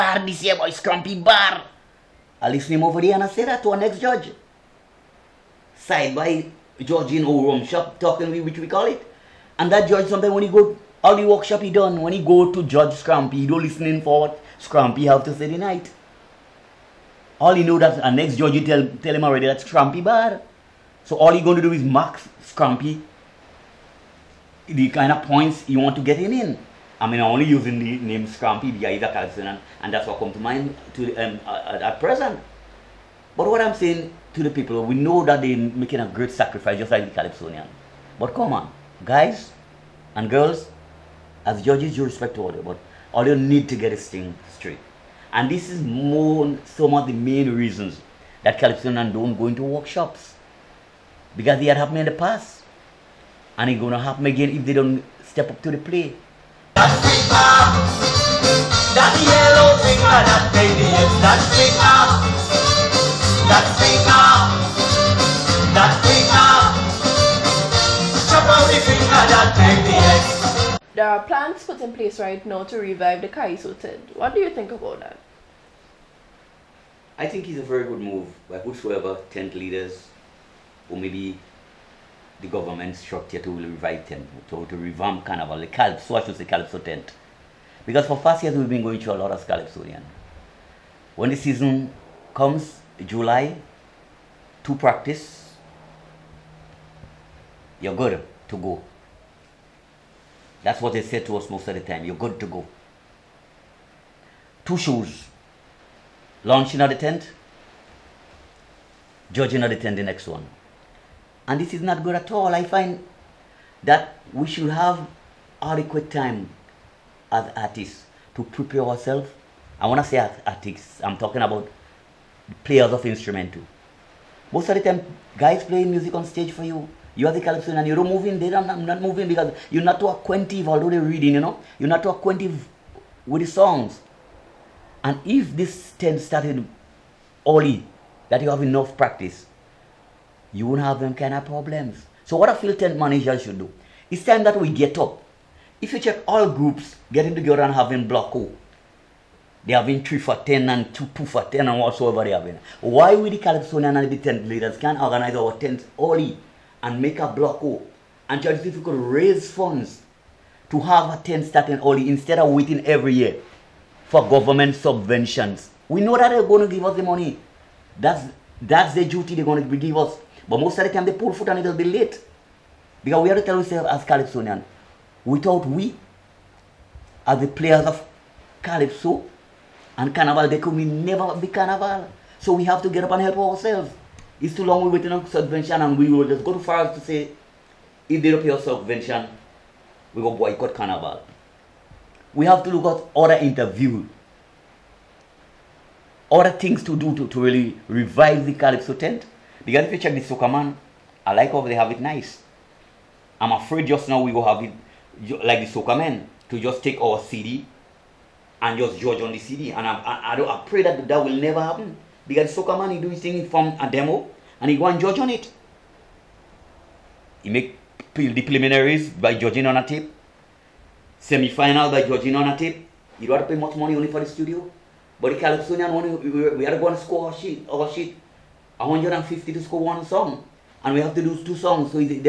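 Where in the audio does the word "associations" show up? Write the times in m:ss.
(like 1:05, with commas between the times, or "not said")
not said.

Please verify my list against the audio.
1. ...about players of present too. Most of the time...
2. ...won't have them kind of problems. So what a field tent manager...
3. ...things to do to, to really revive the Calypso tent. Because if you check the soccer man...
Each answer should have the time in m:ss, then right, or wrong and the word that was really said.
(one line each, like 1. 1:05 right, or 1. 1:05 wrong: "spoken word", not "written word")
1. 2:01 wrong: "instrument", not "present"
2. 2:20 right
3. 3:16 right.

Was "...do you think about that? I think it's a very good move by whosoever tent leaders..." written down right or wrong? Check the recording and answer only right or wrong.
right.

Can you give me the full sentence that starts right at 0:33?
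But what I'm saying to the people, we know that they're making a great sacrifice, just like the Calypsonian.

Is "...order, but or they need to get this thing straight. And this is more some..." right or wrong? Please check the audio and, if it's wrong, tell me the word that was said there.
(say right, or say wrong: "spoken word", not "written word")
right.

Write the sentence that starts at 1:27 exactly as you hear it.
Because for past years we've been going through a lot of calypsonian.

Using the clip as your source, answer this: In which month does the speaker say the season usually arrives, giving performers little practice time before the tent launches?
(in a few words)
July.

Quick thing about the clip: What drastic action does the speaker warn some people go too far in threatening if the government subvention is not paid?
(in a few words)
Boycott carnival.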